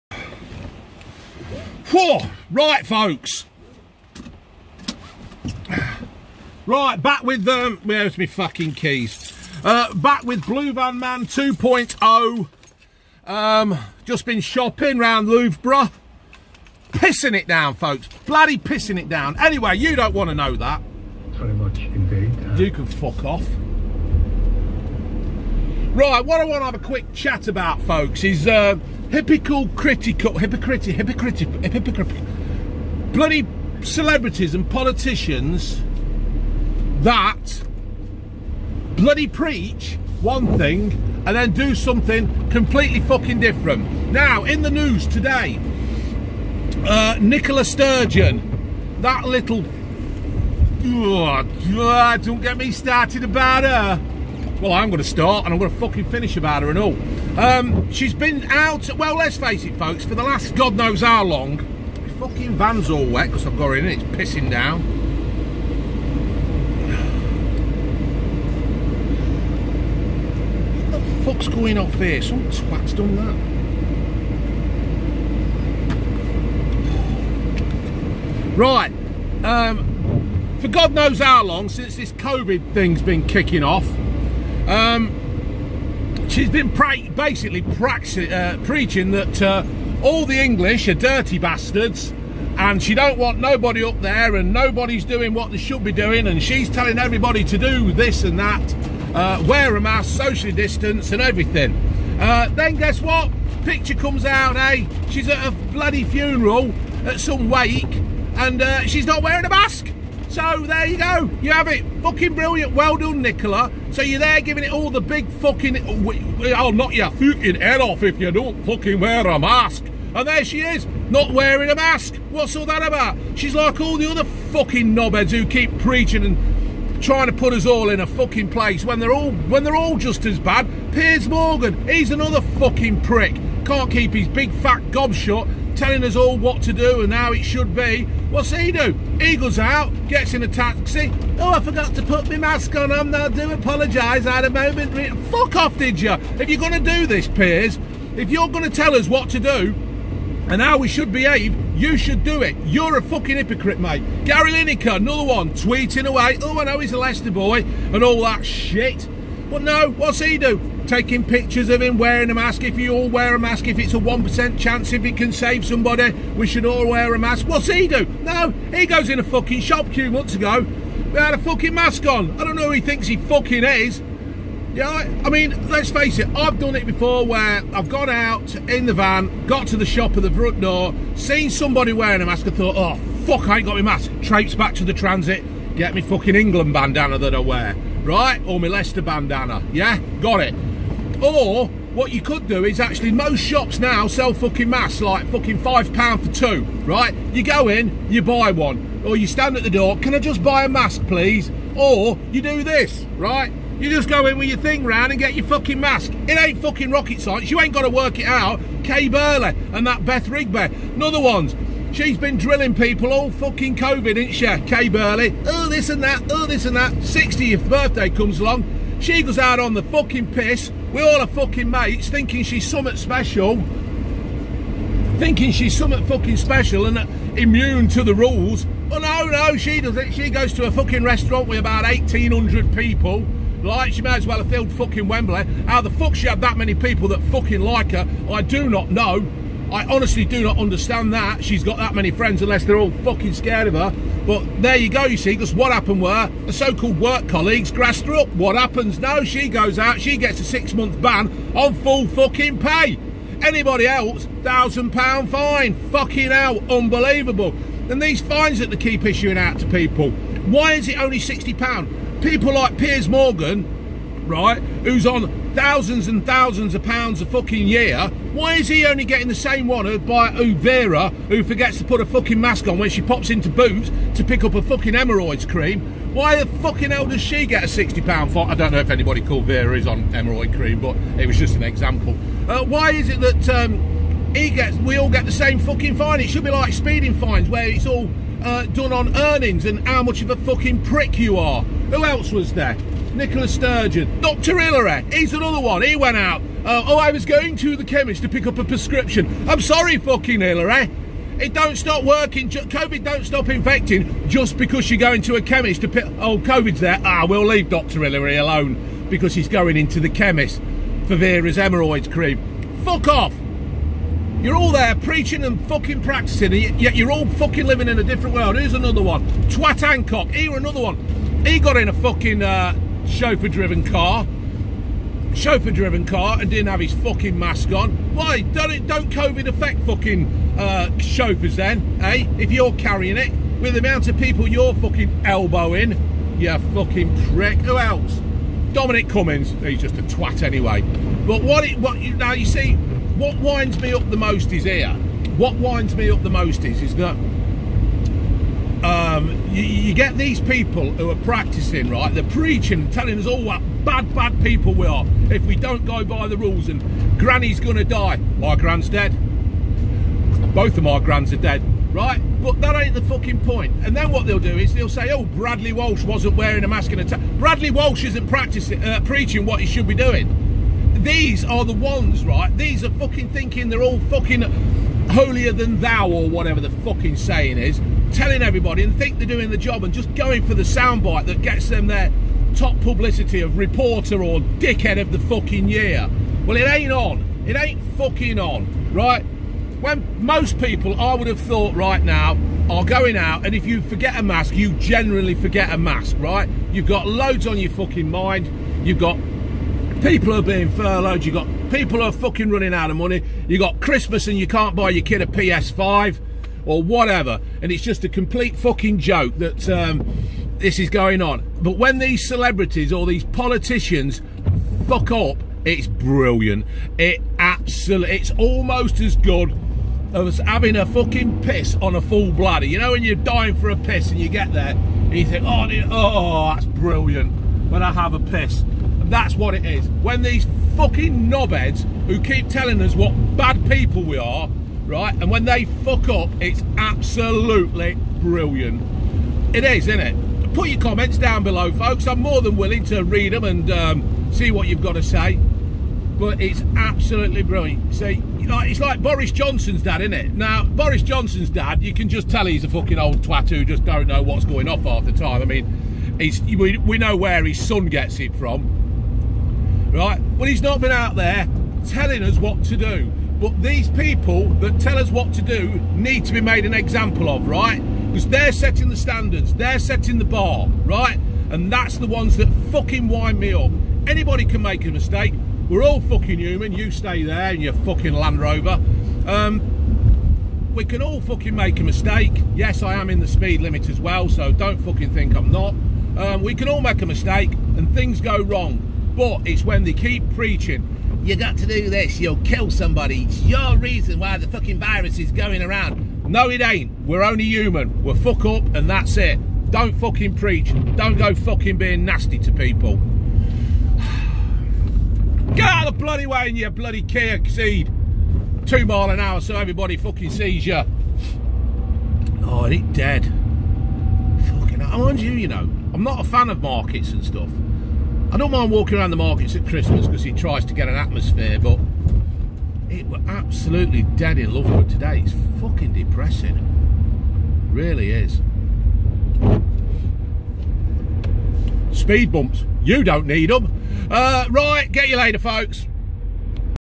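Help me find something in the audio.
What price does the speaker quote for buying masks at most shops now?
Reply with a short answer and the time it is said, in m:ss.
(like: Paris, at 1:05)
£5 for 2, at 3:15.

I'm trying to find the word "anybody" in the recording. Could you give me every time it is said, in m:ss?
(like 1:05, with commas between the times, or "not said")
4:13, 4:38, 7:54.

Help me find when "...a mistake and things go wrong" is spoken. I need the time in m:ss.
8:07.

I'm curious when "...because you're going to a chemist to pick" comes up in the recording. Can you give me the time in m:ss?
5:04.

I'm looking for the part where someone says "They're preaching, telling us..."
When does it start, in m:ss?
5:52.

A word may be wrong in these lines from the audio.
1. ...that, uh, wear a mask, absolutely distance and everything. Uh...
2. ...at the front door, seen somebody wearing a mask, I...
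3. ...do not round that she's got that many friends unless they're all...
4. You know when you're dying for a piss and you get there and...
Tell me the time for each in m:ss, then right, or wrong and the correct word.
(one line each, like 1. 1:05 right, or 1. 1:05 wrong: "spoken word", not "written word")
1. 1:38 wrong: "socially", not "absolutely"
2. 3:00 right
3. 4:00 wrong: "understand", not "round"
4. 7:02 right.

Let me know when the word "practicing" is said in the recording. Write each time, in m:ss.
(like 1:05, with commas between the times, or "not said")
5:16, 5:51, 6:08.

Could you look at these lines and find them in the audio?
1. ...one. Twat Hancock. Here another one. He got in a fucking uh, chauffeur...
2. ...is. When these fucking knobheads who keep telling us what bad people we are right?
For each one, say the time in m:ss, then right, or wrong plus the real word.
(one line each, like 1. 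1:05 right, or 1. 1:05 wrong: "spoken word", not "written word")
1. 5:19 right
2. 7:09 right.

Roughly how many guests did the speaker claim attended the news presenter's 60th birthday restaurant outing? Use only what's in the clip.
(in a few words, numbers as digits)
1,800.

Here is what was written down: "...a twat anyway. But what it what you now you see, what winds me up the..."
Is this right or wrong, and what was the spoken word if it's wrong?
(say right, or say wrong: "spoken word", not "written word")
right.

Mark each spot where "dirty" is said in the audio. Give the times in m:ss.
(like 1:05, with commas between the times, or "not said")
1:30.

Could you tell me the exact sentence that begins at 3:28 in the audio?
Kay Burley and that Beth Rigby, another ones.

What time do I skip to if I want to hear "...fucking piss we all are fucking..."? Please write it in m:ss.
3:39.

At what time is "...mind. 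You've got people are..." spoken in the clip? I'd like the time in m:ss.
6:38.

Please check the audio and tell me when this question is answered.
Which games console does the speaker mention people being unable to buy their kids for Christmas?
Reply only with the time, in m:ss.
6:45.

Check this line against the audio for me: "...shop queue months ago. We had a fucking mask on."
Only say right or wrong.
right.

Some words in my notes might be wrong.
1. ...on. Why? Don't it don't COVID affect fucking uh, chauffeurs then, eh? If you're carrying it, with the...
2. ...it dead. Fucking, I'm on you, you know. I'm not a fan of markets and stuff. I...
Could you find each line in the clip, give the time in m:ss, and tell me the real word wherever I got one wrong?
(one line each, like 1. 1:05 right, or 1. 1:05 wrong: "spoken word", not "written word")
1. 5:27 right
2. 8:32 right.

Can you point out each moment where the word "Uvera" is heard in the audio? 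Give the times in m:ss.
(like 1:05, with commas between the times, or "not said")
4:30.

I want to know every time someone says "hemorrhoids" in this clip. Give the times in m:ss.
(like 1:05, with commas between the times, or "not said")
4:34, 4:40, 5:11.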